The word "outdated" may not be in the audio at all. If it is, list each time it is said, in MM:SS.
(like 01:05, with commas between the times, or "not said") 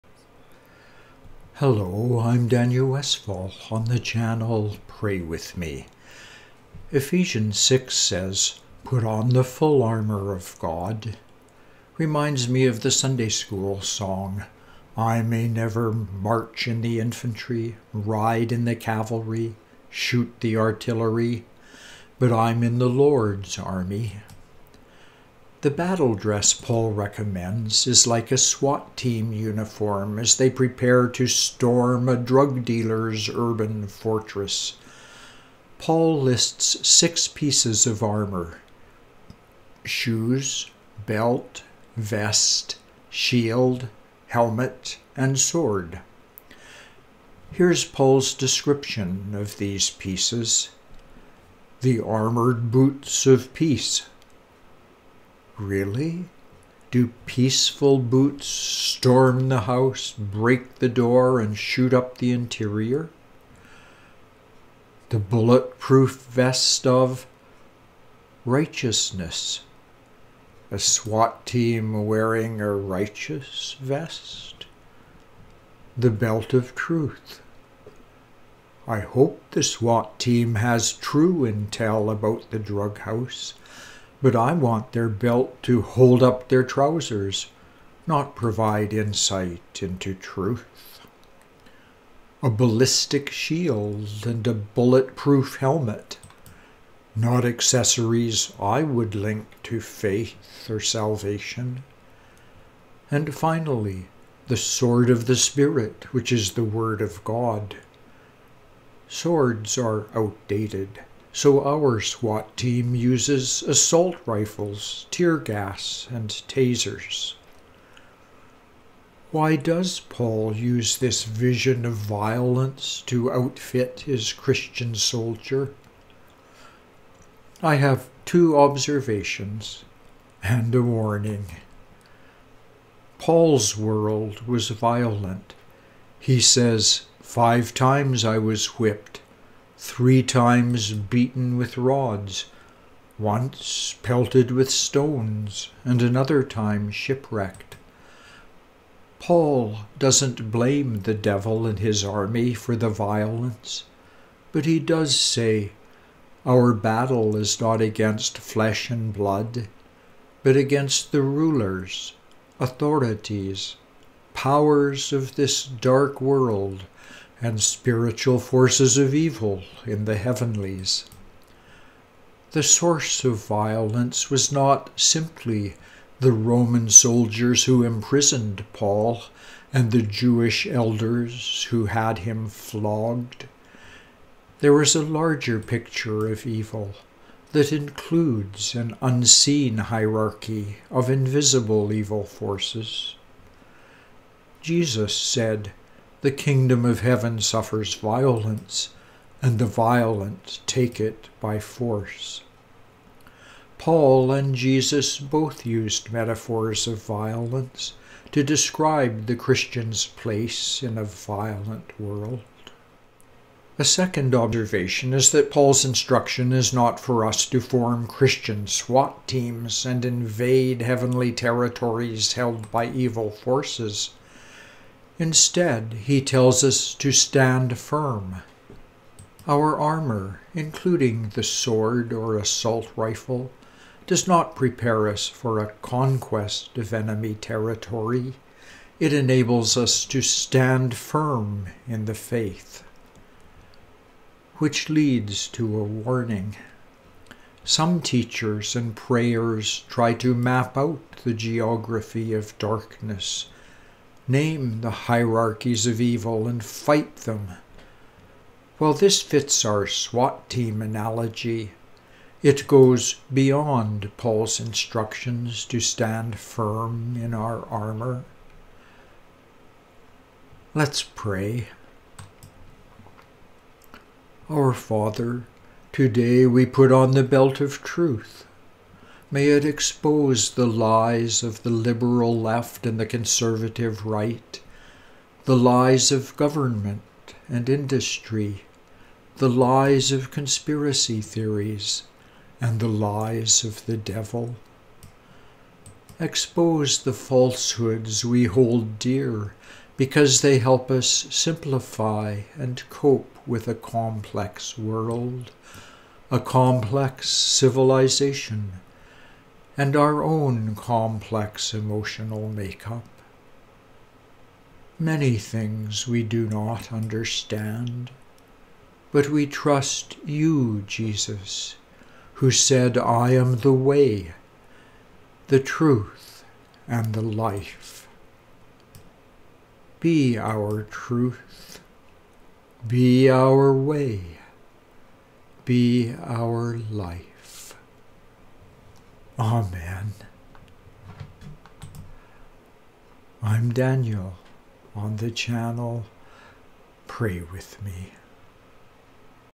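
01:50.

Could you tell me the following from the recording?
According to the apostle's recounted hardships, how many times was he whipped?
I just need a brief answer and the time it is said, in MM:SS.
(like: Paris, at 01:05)
5, at 02:17.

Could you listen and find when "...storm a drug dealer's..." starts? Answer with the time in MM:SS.
00:31.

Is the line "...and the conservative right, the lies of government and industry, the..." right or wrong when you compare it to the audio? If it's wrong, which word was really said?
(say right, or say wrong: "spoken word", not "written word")
right.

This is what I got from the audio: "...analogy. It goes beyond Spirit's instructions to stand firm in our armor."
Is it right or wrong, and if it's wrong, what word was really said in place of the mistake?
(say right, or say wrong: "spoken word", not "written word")
wrong: "Paul", not "Spirit".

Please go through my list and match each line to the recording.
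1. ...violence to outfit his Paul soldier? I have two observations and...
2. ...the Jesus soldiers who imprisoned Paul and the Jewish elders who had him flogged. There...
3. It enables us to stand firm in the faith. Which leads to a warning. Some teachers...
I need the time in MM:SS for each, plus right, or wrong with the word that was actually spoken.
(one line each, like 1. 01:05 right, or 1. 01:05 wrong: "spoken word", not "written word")
1. 02:01 wrong: "Christian", not "Paul"
2. 02:56 wrong: "Roman", not "Jesus"
3. 03:58 right.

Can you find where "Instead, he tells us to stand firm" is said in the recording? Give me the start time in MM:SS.
03:45.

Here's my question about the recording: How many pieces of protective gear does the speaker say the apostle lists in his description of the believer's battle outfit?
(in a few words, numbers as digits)
6.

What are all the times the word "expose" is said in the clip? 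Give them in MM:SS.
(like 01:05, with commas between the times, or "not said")
04:39, 04:56.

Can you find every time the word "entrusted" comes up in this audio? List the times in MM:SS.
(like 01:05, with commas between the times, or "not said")
not said.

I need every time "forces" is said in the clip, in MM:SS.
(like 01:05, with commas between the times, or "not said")
02:48, 03:12, 03:21, 03:43.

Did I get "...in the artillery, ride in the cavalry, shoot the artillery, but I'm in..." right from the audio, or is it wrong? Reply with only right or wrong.
wrong.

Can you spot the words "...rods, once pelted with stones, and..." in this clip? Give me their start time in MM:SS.
02:21.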